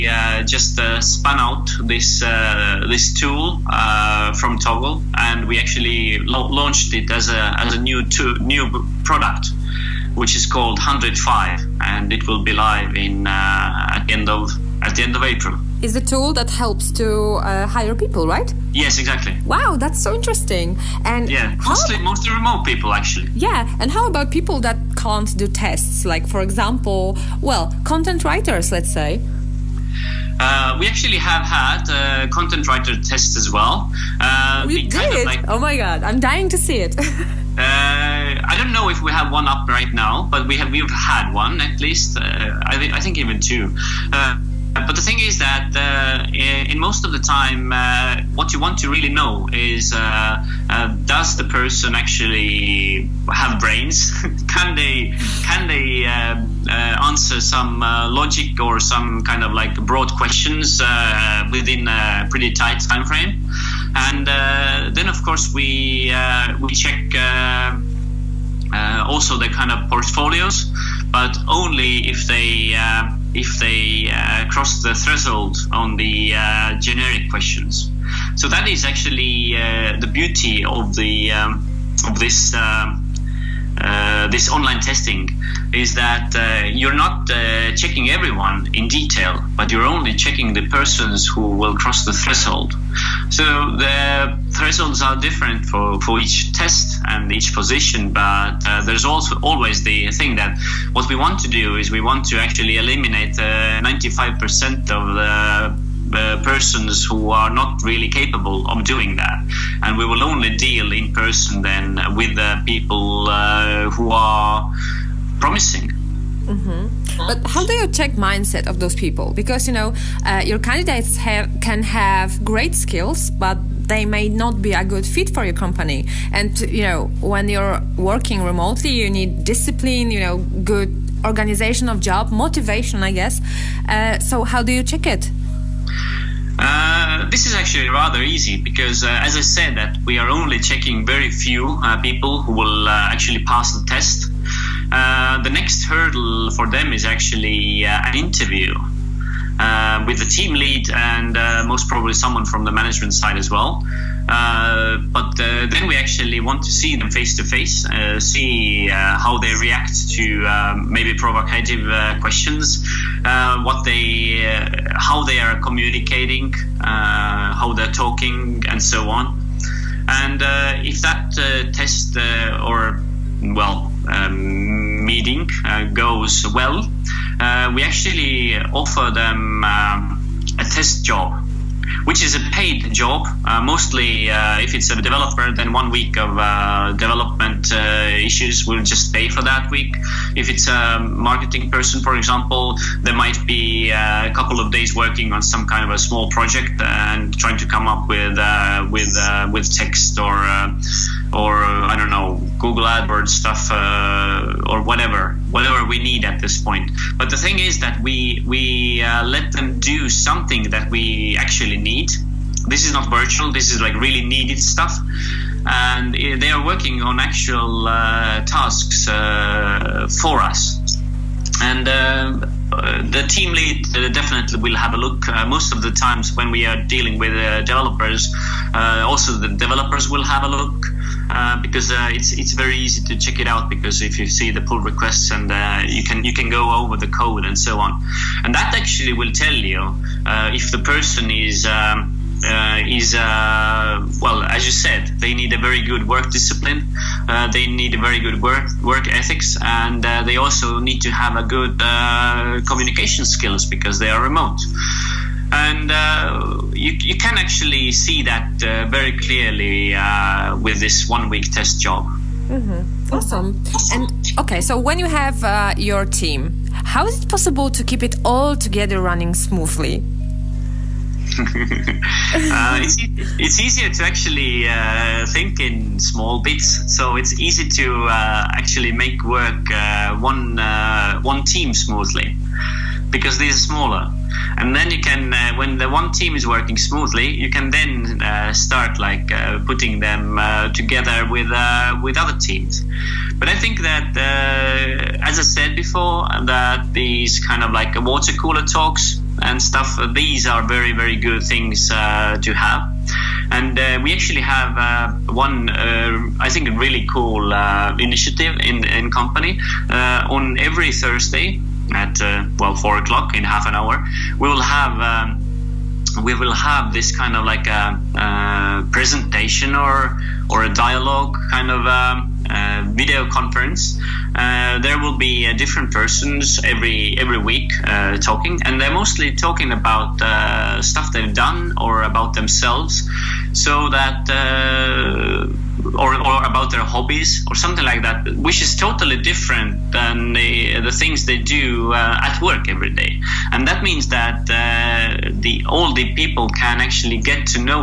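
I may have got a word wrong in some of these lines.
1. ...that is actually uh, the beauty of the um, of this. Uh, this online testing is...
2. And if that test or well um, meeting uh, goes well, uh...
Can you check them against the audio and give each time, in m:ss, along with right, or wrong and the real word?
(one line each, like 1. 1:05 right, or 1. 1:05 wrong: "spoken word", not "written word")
1. 1:18 right
2. 2:50 right.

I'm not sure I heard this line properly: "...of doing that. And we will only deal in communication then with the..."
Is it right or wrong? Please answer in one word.
wrong.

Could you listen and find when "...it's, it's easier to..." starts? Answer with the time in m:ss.
4:32.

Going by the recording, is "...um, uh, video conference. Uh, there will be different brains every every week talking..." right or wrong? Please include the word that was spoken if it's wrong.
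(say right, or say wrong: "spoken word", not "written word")
wrong: "persons", not "brains".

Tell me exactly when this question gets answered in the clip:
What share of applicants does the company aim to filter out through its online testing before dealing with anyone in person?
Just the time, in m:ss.
1:43.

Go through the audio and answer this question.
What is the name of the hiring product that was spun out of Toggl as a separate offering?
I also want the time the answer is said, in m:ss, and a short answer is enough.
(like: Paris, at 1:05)
Hundred5, at 0:10.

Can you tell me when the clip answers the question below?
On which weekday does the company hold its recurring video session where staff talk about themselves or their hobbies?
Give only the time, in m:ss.
5:10.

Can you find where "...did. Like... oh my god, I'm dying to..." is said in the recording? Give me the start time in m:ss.
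0:34.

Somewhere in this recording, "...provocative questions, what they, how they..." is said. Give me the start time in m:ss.
2:41.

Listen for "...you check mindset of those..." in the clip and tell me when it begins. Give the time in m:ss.
1:57.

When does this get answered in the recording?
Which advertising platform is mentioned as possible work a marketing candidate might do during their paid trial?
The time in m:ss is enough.
3:22.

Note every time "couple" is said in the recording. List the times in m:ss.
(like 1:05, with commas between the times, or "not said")
3:14.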